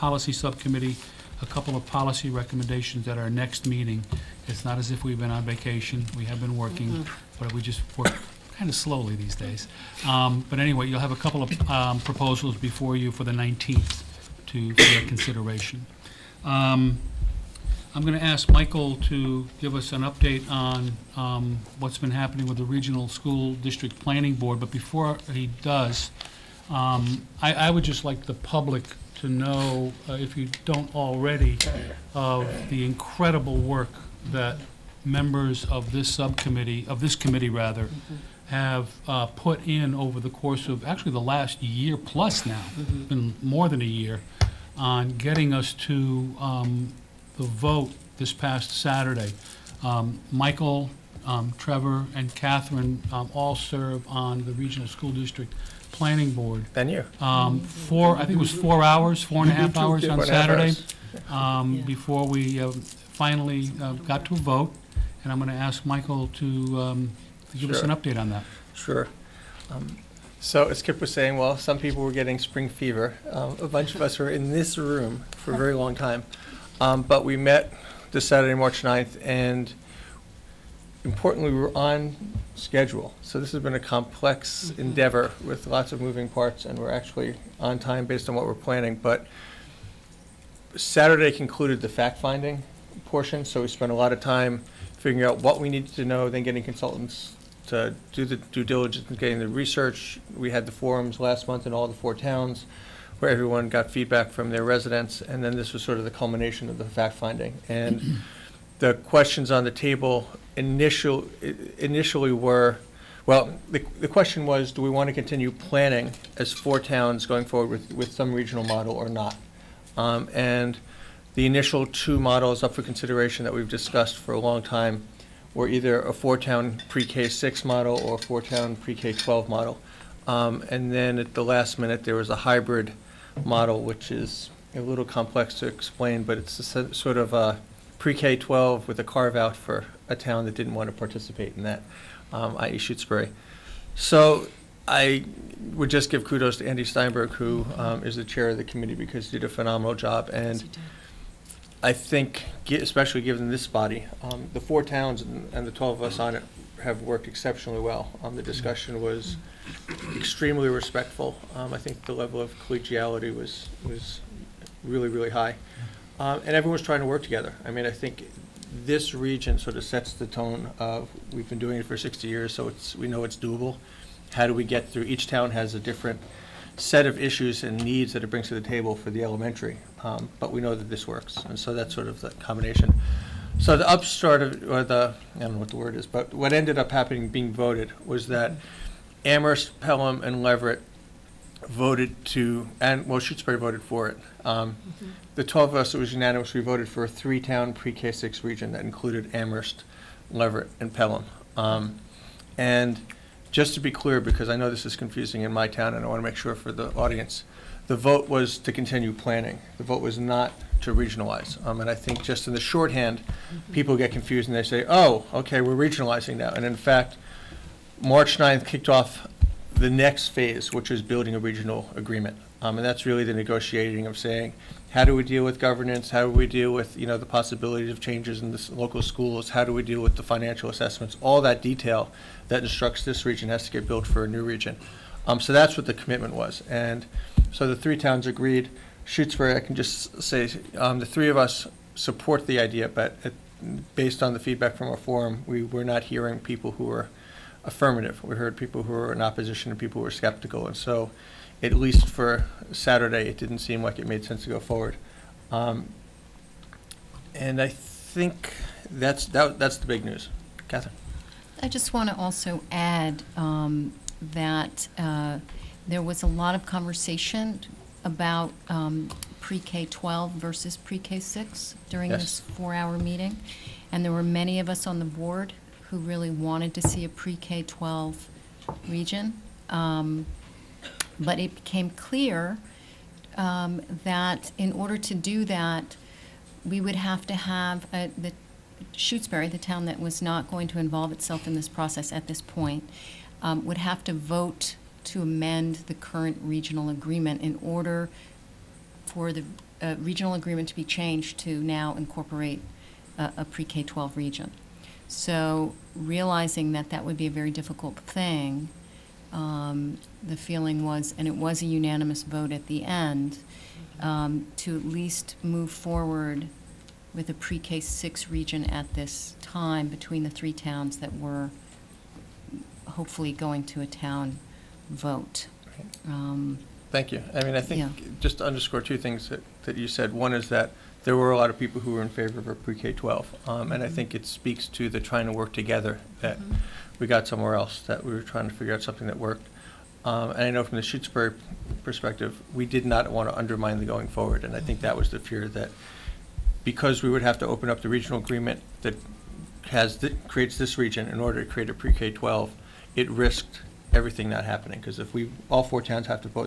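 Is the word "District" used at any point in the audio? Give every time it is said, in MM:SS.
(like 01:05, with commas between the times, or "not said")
00:23, 00:55.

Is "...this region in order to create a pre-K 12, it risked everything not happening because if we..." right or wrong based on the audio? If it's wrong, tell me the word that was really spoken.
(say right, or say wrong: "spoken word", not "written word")
right.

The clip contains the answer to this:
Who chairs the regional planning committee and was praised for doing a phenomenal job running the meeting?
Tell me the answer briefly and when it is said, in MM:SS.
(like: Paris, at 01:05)
Andy Steinberg, at 02:26.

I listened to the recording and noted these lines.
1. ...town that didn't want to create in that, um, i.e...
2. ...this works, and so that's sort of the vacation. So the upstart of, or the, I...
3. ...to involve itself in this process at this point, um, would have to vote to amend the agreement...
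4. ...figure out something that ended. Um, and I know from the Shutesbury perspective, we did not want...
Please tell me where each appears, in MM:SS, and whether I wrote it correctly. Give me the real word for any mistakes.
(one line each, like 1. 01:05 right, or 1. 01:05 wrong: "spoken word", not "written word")
1. 02:20 wrong: "participate", not "create"
2. 03:00 wrong: "combination", not "vacation"
3. 04:50 wrong: "current", not "agreement"
4. 05:38 wrong: "worked", not "ended".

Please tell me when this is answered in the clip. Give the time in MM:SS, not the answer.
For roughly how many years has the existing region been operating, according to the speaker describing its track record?
02:51.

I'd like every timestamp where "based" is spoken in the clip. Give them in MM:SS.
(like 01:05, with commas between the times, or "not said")
01:28, 04:03.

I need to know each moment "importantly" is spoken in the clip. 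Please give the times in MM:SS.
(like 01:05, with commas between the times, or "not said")
01:21.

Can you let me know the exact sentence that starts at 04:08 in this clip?
We heard people who were in opposition and people who were skeptical.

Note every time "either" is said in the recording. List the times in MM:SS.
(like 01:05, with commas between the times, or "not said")
02:05.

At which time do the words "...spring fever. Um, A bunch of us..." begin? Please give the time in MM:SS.
01:12.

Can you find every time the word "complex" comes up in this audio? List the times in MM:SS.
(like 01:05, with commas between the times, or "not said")
01:23, 02:15.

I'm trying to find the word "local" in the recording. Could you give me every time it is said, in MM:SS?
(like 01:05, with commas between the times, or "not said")
03:48.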